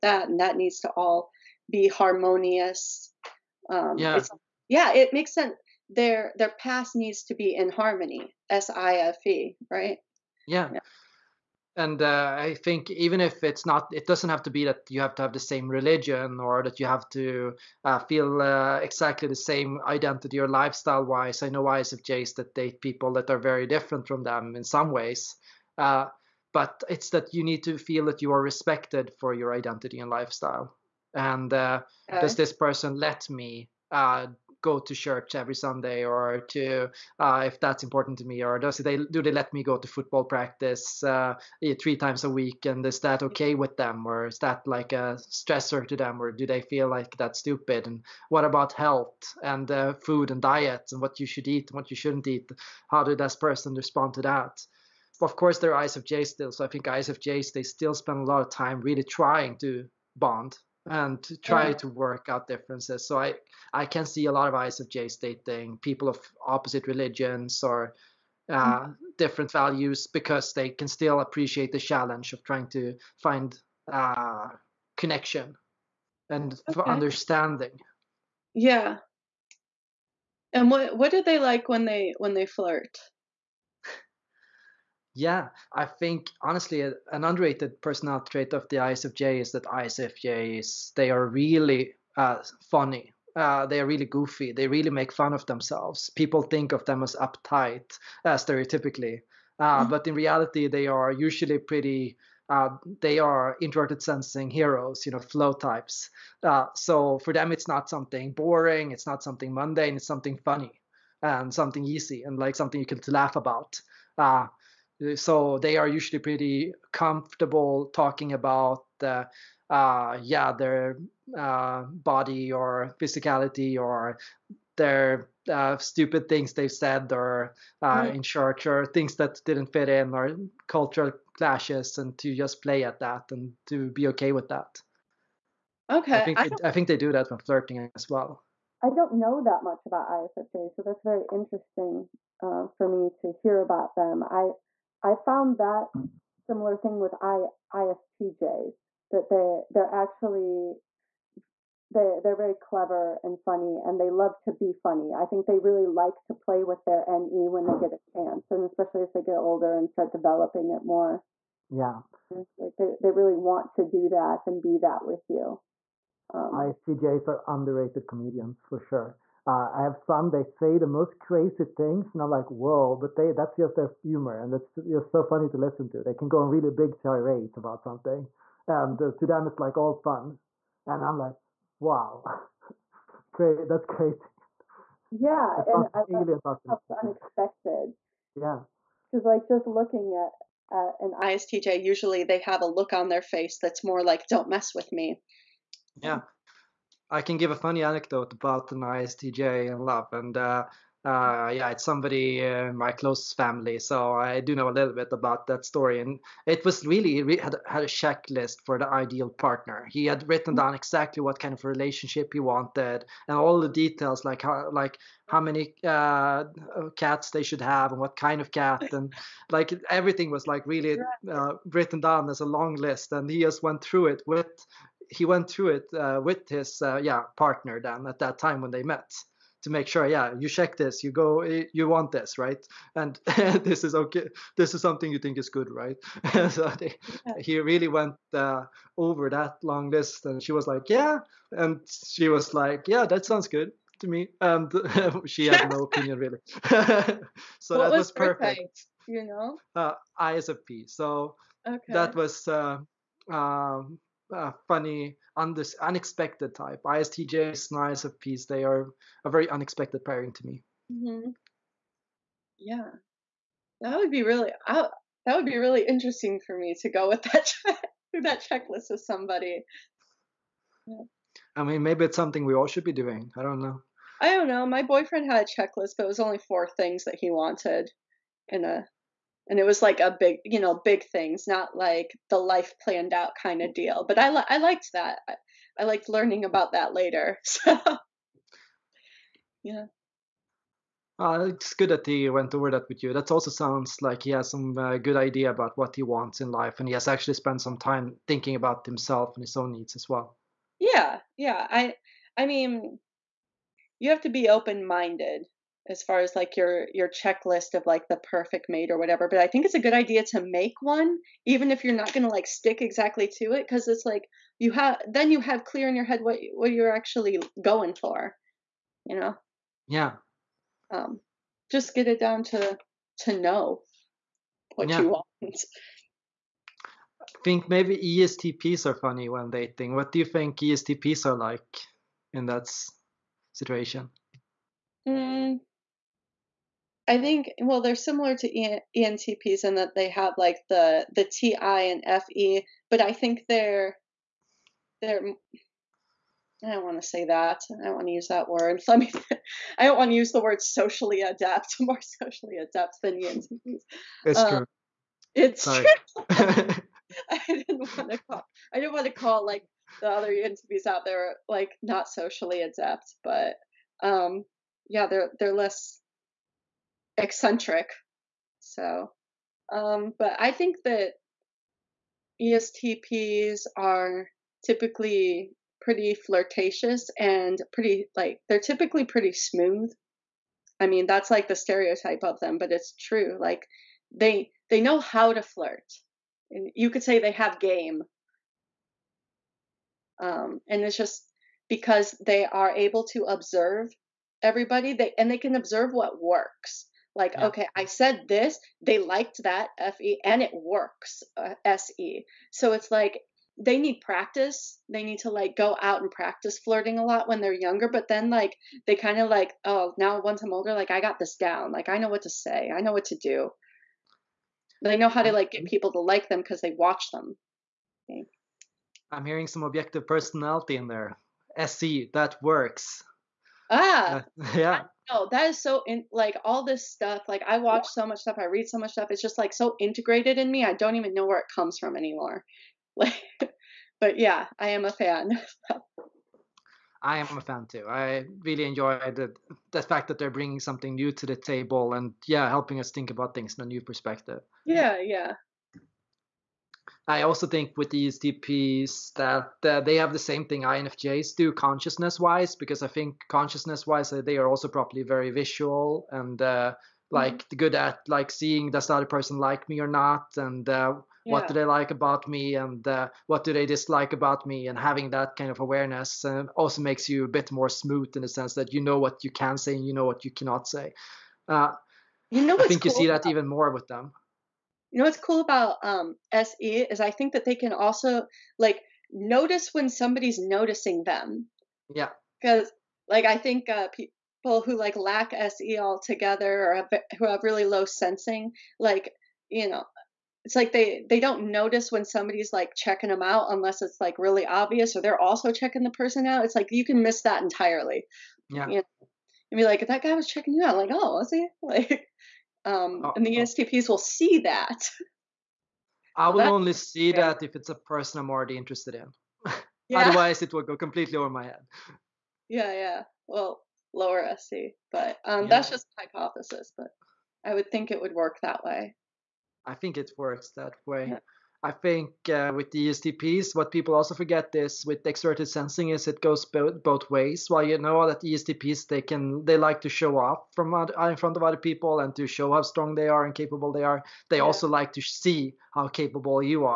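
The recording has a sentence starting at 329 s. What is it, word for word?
What do you think ESTPs are like in that situation?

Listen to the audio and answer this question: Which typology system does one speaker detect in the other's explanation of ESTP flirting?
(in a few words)
objective personality.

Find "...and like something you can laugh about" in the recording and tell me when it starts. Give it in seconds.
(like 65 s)
112 s.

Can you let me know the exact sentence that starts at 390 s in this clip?
Um, and it's just because they are able to observe everybody they and they can observe what works like, yeah.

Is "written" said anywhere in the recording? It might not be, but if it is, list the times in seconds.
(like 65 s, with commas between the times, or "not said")
210 s, 221 s.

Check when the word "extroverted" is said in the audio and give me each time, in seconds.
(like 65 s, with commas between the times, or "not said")
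525 s.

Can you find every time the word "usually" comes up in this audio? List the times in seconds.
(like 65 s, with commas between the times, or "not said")
101 s, 115 s, 191 s.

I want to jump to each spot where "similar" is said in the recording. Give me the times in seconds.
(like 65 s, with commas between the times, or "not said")
146 s, 337 s.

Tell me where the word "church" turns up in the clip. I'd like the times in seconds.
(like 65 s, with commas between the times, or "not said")
34 s, 128 s.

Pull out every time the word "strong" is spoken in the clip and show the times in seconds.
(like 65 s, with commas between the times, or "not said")
532 s.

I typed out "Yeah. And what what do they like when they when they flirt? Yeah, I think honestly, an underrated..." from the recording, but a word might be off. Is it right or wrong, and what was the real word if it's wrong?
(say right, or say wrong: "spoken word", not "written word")
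right.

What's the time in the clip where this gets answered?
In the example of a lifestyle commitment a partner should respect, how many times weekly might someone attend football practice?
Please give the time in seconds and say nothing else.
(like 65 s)
41 s.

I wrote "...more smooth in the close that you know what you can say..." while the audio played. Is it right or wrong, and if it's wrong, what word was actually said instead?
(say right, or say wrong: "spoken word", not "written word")
wrong: "sense", not "close".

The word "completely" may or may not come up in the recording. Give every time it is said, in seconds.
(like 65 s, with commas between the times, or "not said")
510 s.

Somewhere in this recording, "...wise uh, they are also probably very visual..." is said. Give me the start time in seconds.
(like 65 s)
453 s.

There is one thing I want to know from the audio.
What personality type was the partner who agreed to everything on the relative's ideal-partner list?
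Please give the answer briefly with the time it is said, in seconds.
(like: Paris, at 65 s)
ISFP, at 250 s.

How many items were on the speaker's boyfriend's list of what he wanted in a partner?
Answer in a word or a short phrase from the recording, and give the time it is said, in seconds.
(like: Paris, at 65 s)
4, at 276 s.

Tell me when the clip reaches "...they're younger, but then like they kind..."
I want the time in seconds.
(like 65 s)
407 s.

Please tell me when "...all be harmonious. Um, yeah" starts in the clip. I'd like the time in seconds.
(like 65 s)
0 s.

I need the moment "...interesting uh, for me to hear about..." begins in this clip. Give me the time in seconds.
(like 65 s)
141 s.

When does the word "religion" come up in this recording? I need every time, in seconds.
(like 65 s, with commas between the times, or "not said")
15 s, 66 s.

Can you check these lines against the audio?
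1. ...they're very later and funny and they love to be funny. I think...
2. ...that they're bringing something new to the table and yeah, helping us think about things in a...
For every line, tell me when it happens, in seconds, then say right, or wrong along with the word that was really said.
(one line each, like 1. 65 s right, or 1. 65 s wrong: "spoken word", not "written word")
1. 152 s wrong: "clever", not "later"
2. 440 s right.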